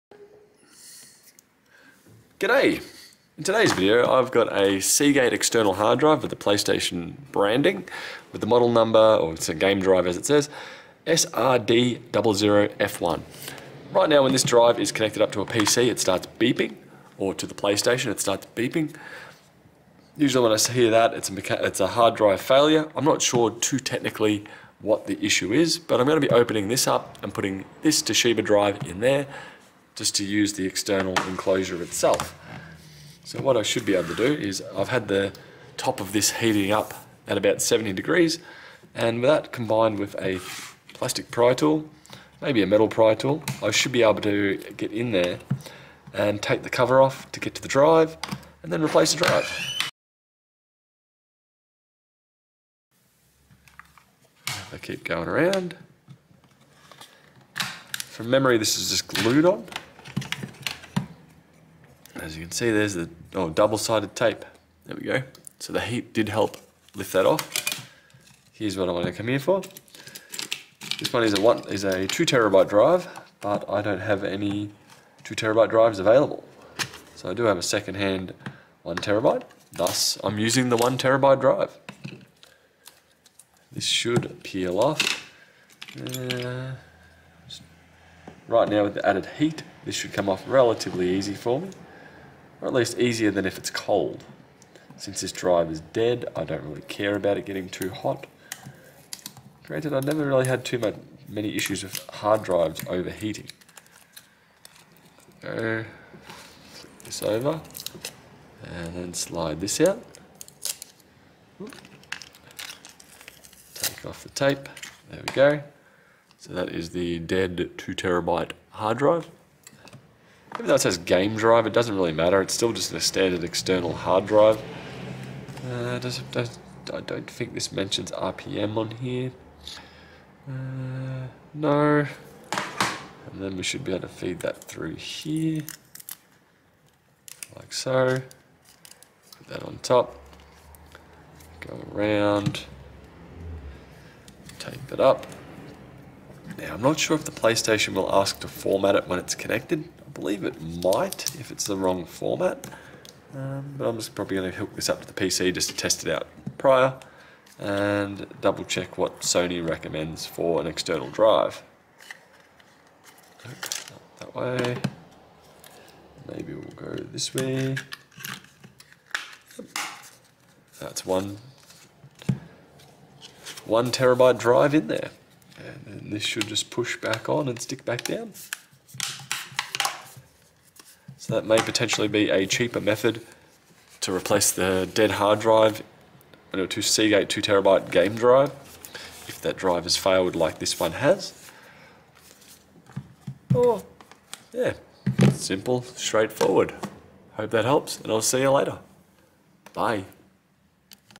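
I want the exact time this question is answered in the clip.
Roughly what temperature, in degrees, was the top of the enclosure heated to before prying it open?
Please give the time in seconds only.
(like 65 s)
37 s.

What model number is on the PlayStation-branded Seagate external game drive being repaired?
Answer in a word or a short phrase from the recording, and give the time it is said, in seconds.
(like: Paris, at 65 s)
SRD00F1, at 11 s.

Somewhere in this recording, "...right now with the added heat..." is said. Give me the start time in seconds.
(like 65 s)
88 s.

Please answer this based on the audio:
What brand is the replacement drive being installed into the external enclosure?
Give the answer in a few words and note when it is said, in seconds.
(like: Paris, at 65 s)
Toshiba, at 28 s.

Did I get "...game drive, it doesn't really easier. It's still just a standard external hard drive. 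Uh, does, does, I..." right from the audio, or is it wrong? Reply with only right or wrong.
wrong.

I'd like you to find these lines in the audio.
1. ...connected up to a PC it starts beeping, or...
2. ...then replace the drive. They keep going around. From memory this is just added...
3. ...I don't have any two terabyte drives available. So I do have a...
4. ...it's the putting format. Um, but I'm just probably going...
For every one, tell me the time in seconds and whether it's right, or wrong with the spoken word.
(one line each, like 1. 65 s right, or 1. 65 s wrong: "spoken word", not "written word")
1. 14 s right
2. 48 s wrong: "glued", not "added"
3. 73 s right
4. 151 s wrong: "wrong", not "putting".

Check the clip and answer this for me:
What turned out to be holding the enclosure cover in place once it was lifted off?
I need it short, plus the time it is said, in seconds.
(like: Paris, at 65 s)
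Double-sided tape, at 63 s.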